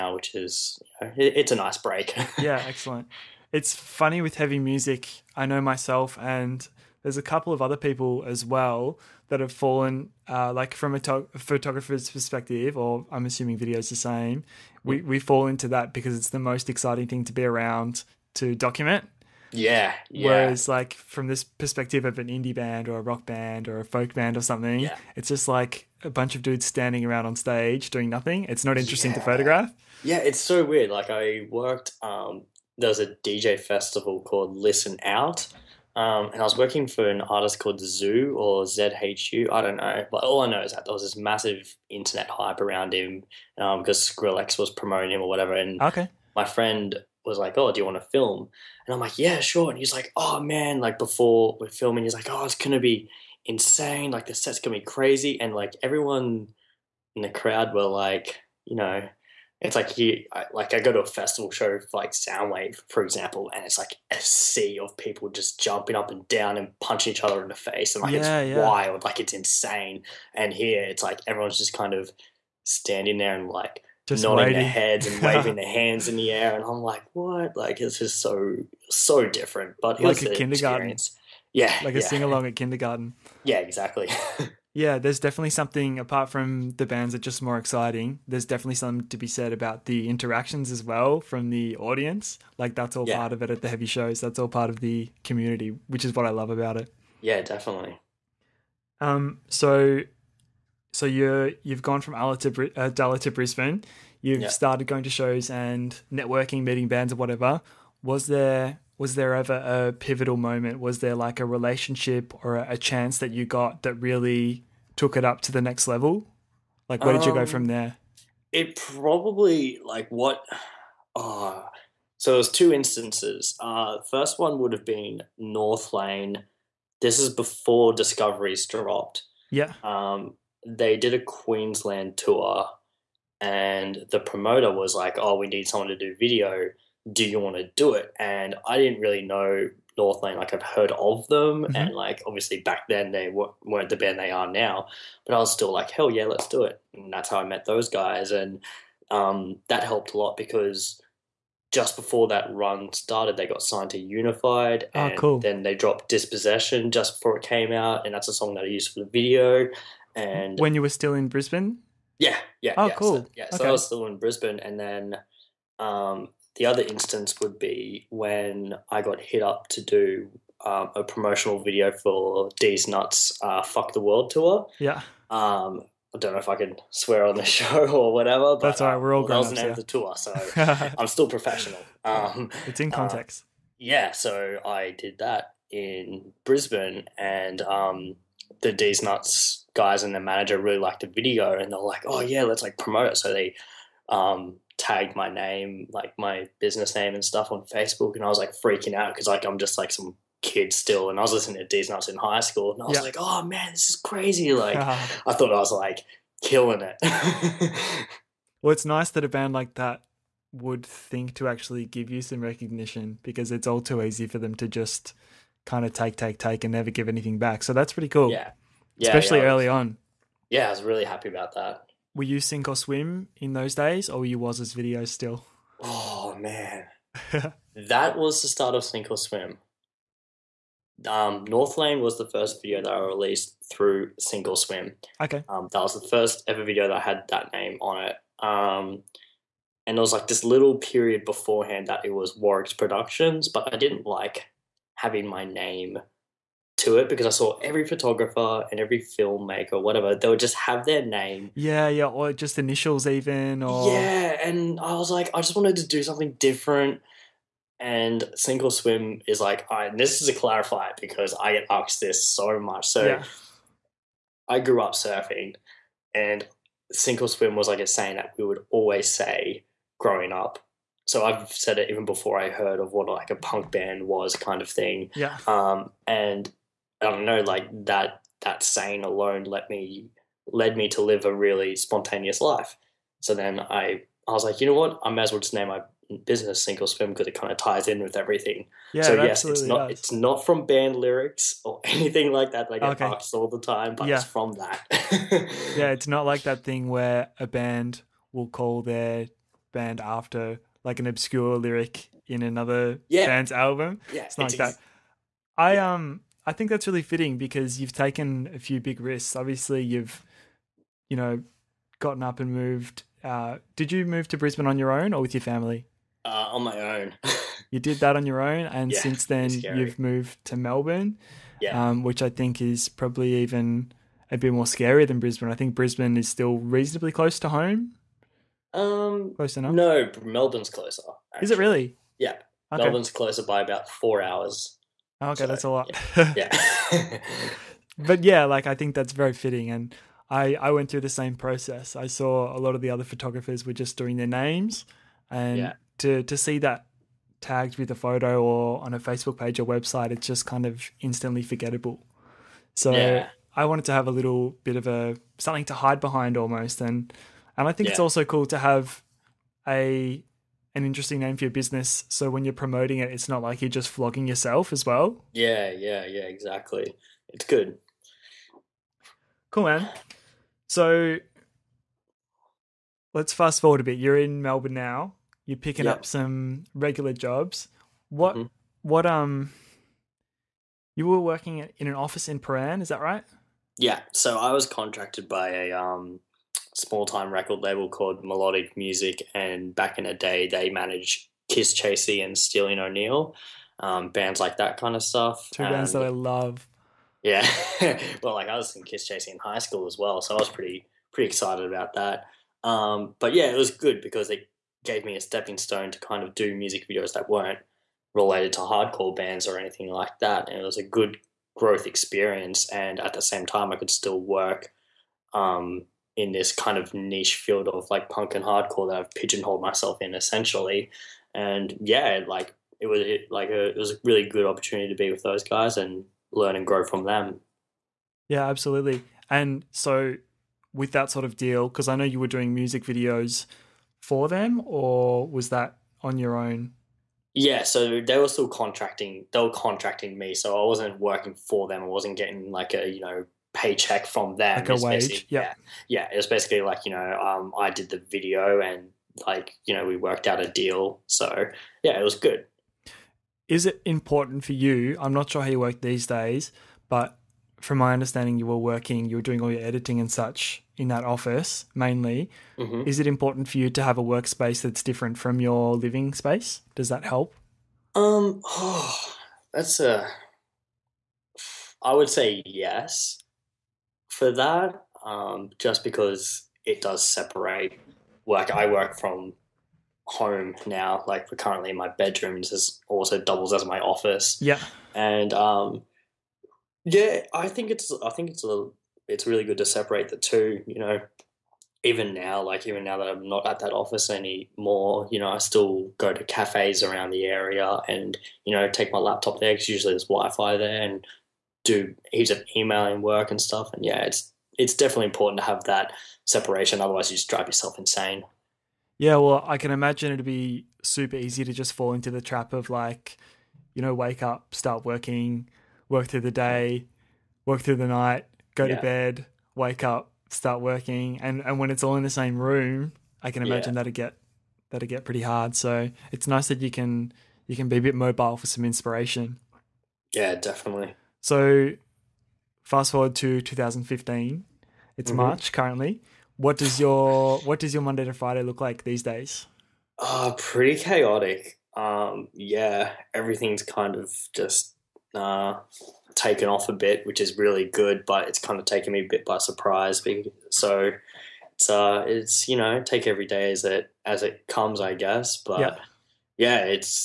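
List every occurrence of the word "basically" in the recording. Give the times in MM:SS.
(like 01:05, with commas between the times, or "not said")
07:26.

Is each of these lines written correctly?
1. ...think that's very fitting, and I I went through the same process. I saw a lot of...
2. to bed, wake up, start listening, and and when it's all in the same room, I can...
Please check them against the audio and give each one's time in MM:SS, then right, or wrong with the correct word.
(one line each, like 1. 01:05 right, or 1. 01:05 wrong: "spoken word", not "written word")
1. 05:38 right
2. 08:38 wrong: "working", not "listening".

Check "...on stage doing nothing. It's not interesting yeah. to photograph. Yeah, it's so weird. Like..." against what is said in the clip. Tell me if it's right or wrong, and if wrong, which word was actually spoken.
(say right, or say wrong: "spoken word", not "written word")
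right.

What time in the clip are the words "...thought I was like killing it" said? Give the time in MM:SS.
03:25.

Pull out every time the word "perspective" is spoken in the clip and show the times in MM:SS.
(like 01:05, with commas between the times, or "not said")
00:12, 00:21.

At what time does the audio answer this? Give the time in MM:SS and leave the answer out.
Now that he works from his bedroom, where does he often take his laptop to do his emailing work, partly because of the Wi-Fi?
08:16.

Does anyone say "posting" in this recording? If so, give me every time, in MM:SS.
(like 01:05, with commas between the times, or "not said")
not said.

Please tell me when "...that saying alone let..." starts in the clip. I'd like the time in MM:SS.
04:38.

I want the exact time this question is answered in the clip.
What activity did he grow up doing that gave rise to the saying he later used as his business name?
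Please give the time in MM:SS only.
04:24.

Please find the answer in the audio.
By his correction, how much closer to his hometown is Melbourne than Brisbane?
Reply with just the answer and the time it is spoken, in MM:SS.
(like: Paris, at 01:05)
About 4 hours, at 05:33.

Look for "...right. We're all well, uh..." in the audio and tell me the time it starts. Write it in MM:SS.
02:58.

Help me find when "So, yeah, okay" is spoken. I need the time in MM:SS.
02:43.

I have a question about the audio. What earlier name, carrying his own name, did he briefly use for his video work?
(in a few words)
Warwick's Productions.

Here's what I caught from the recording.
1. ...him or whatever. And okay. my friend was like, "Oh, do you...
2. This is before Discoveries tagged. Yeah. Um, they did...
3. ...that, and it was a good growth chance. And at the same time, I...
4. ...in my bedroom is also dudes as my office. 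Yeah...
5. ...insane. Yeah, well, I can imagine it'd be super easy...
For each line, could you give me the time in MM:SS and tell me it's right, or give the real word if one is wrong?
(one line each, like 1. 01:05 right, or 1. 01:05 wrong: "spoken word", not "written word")
1. 00:45 right
2. 02:06 wrong: "dropped", not "tagged"
3. 06:50 wrong: "experience", not "chance"
4. 08:01 wrong: "doubles", not "dudes"
5. 08:27 right.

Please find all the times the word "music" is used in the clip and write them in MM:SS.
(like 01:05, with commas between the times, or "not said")
00:04, 06:28, 06:46, 07:12.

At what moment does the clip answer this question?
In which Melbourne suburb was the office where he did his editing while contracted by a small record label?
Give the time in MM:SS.
06:22.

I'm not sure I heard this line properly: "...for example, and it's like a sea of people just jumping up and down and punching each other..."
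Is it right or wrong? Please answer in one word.
right.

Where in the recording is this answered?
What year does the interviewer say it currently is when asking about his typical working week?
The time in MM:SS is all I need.
08:53.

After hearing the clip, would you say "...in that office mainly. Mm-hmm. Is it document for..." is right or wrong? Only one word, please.
wrong.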